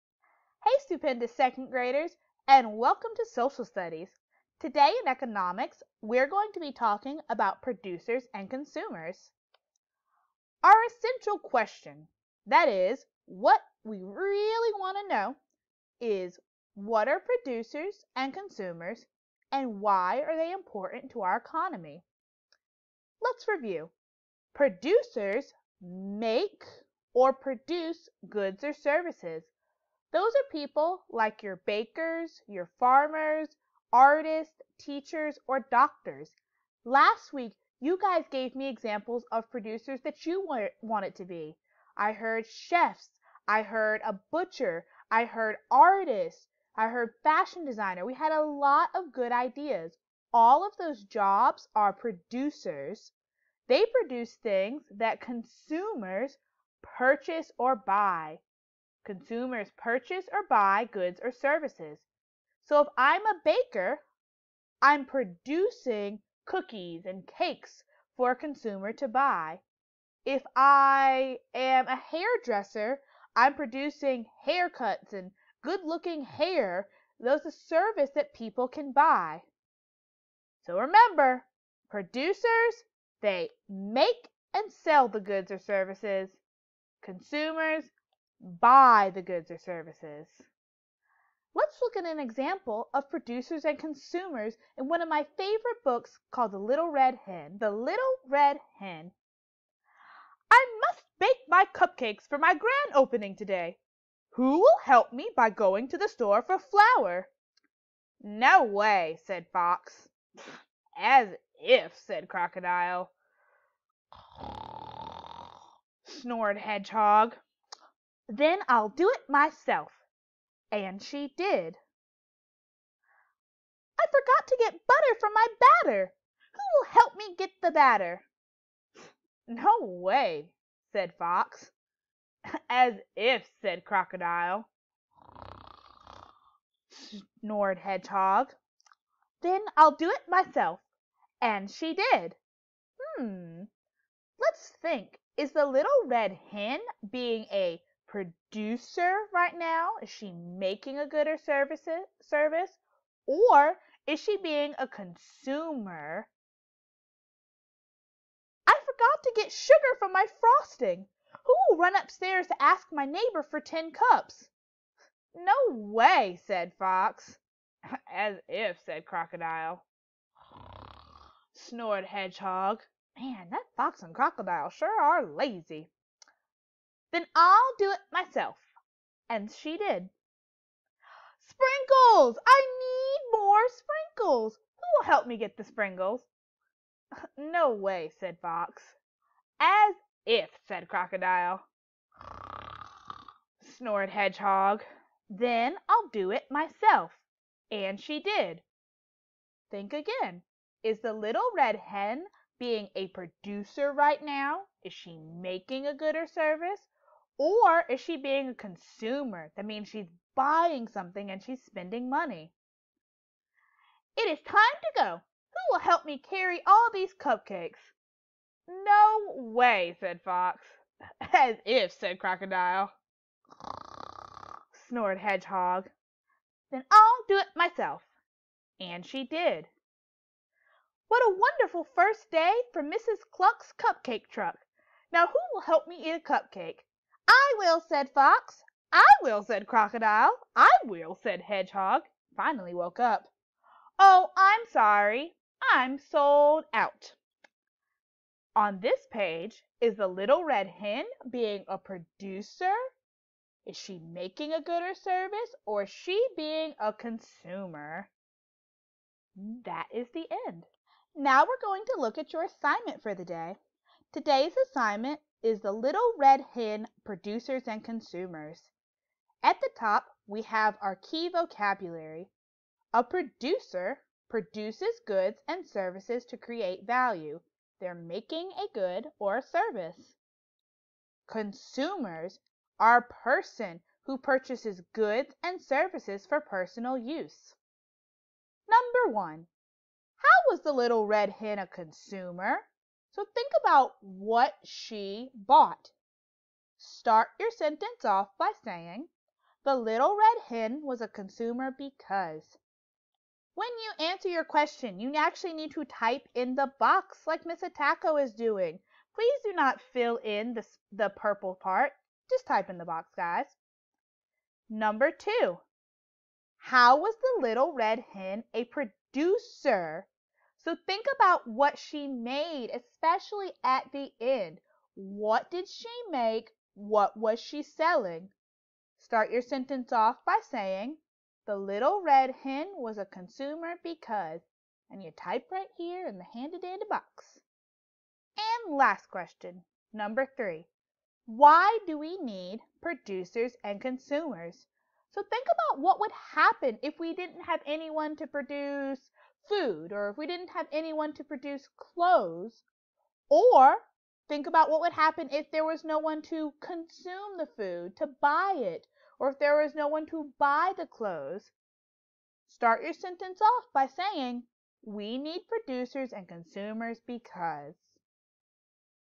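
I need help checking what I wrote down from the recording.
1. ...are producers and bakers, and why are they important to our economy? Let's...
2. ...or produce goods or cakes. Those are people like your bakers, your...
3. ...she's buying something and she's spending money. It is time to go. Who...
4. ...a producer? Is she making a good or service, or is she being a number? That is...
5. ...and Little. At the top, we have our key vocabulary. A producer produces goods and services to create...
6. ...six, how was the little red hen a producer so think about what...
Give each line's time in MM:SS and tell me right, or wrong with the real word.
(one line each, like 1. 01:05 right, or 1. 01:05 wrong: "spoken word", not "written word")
1. 00:17 wrong: "consumers", not "bakers"
2. 00:27 wrong: "services", not "cakes"
3. 03:29 right
4. 04:11 wrong: "consumer", not "number"
5. 04:27 wrong: "Consumers", not "Little"
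6. 05:15 wrong: "two", not "six".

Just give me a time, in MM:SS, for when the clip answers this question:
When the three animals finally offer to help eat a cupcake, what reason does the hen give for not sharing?
04:05.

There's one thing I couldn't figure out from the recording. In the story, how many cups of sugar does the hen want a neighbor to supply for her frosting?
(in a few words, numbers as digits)
10.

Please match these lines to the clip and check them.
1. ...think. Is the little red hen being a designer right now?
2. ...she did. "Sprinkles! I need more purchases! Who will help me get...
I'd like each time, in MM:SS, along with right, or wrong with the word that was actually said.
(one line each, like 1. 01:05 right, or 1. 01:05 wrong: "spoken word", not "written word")
1. 02:24 wrong: "producer", not "designer"
2. 02:59 wrong: "sprinkles", not "purchases".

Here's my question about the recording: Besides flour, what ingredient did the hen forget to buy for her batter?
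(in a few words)
butter.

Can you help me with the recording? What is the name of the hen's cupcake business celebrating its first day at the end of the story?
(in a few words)
Mrs. Cluck's cupcake truck.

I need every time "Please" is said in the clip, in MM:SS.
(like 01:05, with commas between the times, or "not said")
05:09.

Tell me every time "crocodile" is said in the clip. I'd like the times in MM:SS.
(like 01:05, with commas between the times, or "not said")
01:52, 02:13, 02:49, 02:54, 03:10, 03:42, 03:59.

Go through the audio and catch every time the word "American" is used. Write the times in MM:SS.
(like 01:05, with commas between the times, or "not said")
not said.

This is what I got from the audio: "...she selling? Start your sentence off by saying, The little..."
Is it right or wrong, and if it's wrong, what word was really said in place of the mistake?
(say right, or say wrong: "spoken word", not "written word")
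right.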